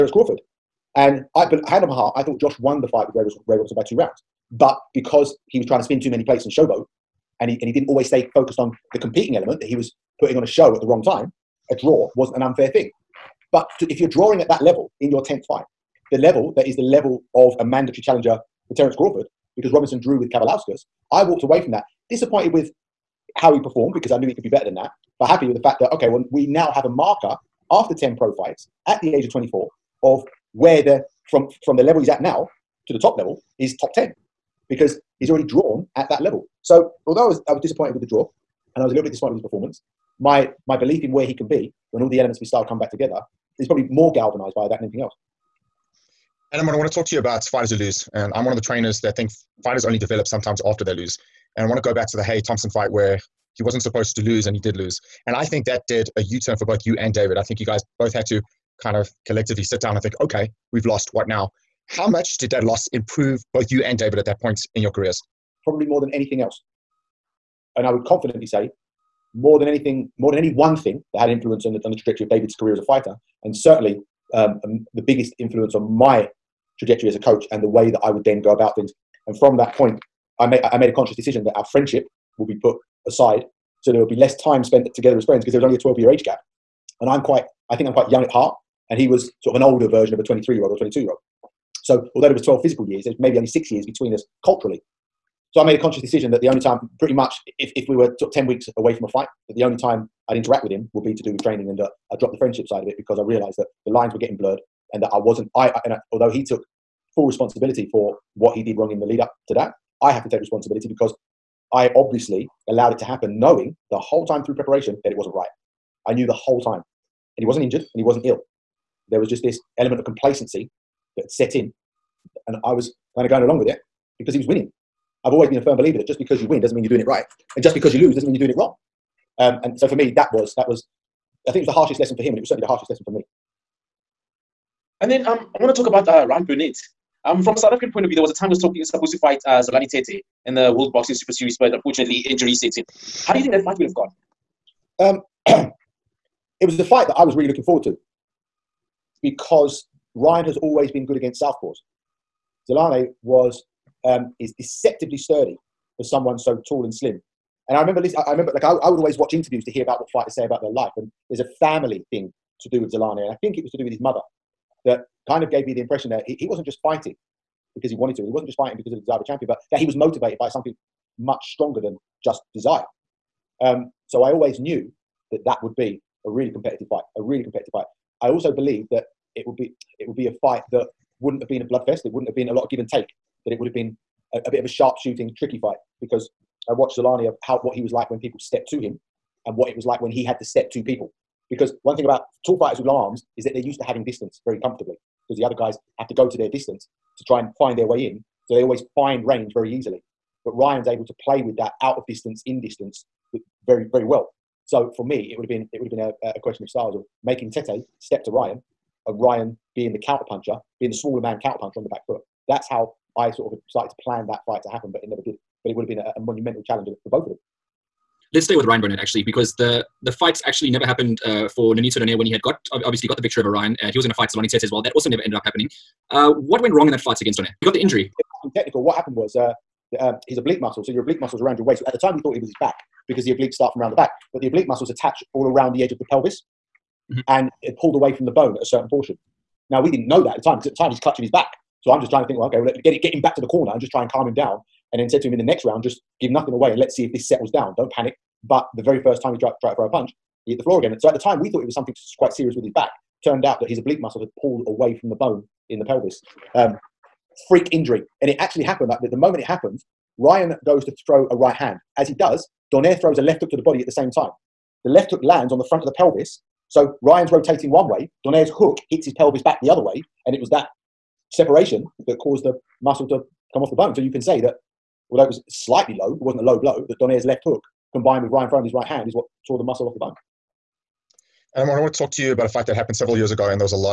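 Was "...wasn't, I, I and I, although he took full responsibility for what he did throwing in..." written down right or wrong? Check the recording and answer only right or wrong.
wrong.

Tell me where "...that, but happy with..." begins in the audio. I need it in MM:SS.
00:24.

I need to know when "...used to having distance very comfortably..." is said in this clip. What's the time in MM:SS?
03:13.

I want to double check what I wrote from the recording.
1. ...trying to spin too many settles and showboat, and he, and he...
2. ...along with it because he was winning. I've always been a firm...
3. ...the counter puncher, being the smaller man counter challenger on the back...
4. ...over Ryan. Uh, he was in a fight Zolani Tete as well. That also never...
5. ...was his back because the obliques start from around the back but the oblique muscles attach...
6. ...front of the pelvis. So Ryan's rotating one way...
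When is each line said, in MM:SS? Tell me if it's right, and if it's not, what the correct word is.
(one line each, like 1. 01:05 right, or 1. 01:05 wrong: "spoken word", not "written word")
1. 00:05 wrong: "plates", not "settles"
2. 02:03 right
3. 03:29 wrong: "puncher", not "challenger"
4. 03:43 right
5. 03:52 right
6. 04:25 right.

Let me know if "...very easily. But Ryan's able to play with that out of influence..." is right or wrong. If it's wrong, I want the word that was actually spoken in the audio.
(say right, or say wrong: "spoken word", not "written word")
wrong: "distance", not "influence".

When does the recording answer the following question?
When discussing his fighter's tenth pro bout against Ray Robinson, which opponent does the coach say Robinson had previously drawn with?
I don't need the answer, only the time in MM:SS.
00:20.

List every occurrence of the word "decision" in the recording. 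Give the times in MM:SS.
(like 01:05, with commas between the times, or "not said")
01:21, 01:36.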